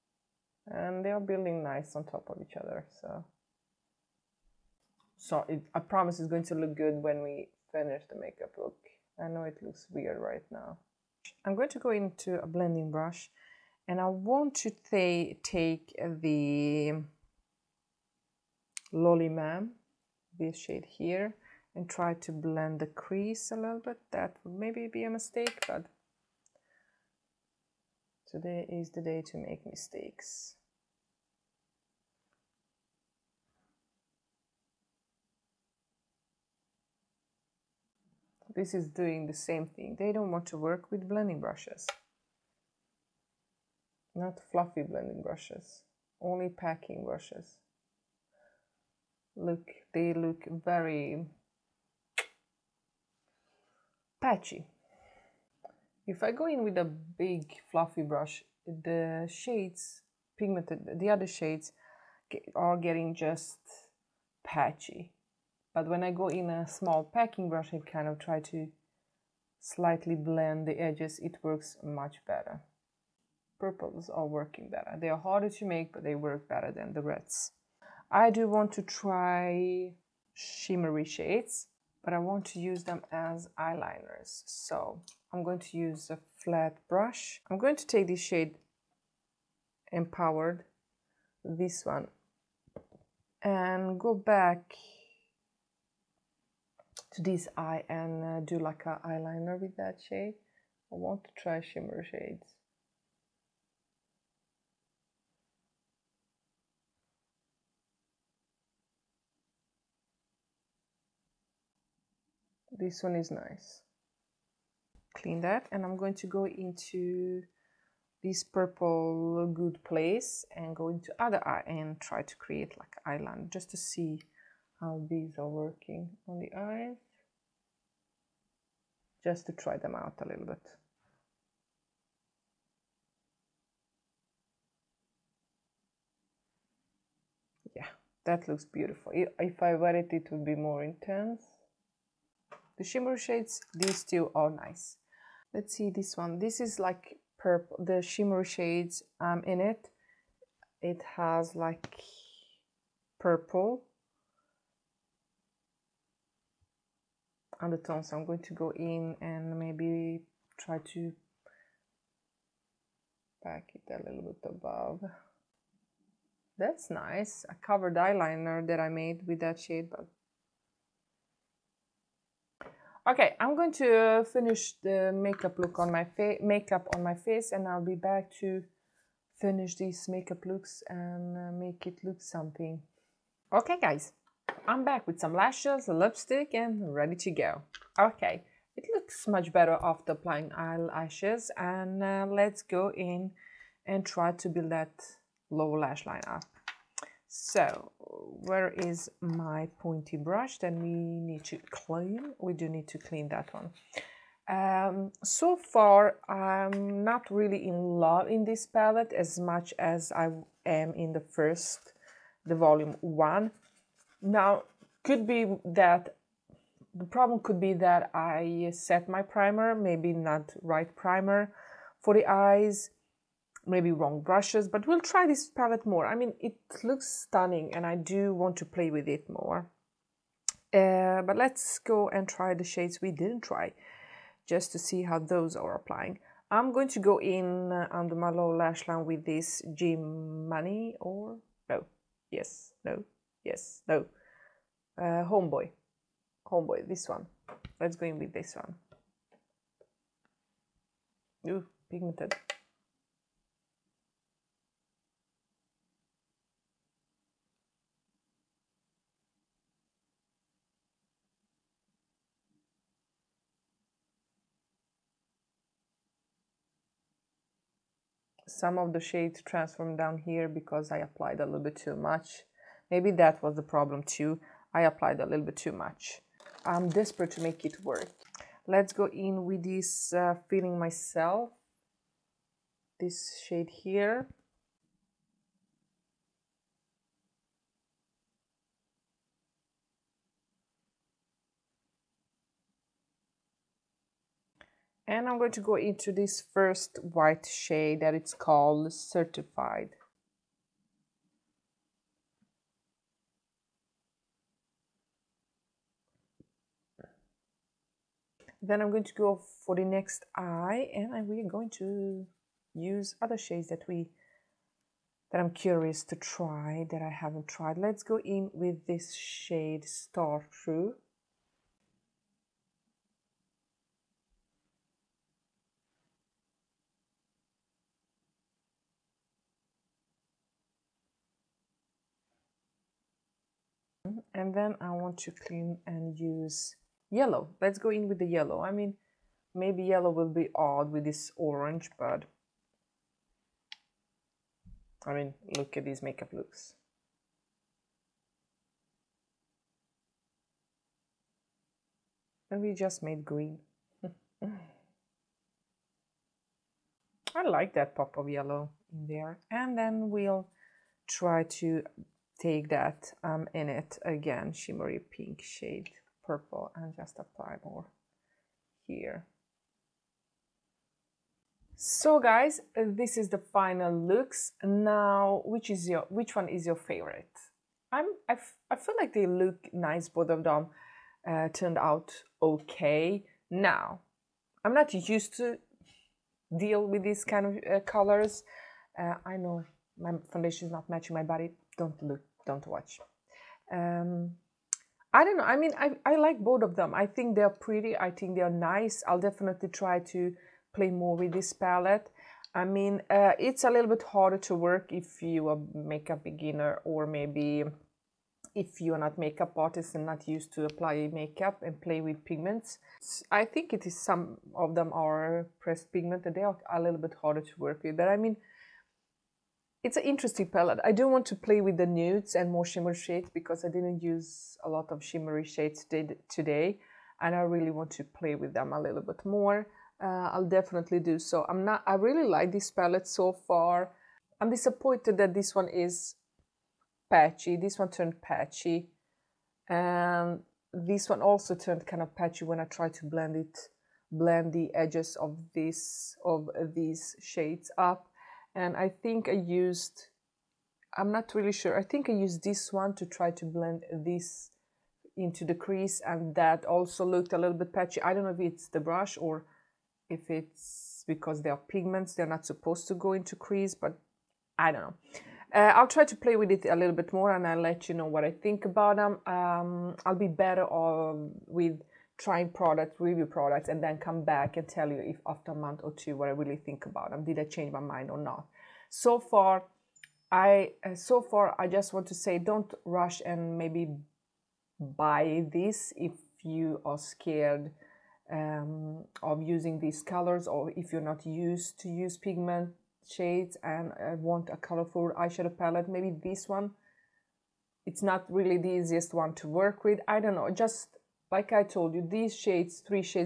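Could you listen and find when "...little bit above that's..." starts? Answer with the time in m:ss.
2:44.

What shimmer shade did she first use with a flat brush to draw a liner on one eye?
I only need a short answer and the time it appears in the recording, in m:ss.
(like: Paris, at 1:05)
Empowered, at 1:29.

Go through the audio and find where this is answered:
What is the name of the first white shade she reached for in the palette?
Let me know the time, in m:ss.
4:58.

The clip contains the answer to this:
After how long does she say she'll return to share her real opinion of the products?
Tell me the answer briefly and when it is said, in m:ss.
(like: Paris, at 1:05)
a month or two, at 7:55.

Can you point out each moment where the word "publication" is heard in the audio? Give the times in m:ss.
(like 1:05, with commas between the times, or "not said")
not said.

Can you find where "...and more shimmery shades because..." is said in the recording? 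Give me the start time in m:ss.
7:02.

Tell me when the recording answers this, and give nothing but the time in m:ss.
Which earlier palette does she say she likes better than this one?
3:32.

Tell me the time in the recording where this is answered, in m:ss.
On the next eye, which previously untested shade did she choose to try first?
5:19.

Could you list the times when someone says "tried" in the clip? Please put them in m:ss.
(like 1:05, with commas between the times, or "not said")
5:17, 7:22.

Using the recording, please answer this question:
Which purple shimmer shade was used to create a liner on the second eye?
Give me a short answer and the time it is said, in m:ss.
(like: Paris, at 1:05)
Good Place, at 1:59.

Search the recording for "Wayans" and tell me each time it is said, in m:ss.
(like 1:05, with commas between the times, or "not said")
not said.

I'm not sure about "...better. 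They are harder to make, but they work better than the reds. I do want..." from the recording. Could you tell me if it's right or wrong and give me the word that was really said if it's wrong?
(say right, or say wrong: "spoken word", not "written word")
right.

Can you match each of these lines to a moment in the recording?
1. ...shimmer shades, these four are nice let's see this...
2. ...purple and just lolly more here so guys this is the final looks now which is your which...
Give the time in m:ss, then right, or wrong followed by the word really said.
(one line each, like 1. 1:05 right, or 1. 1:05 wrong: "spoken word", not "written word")
1. 2:22 wrong: "two", not "four"
2. 6:06 wrong: "apply", not "lolly".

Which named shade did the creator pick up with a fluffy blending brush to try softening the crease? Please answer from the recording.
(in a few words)
Lolly mam.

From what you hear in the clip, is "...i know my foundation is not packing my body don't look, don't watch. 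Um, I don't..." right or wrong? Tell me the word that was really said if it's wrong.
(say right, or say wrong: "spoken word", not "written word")
wrong: "matching", not "packing".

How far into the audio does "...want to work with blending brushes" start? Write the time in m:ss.
0:40.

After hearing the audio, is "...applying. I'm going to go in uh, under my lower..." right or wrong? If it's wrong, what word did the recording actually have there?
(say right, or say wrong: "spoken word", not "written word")
right.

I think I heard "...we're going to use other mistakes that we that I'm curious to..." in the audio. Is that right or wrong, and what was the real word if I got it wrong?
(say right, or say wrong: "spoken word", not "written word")
wrong: "shades", not "mistakes".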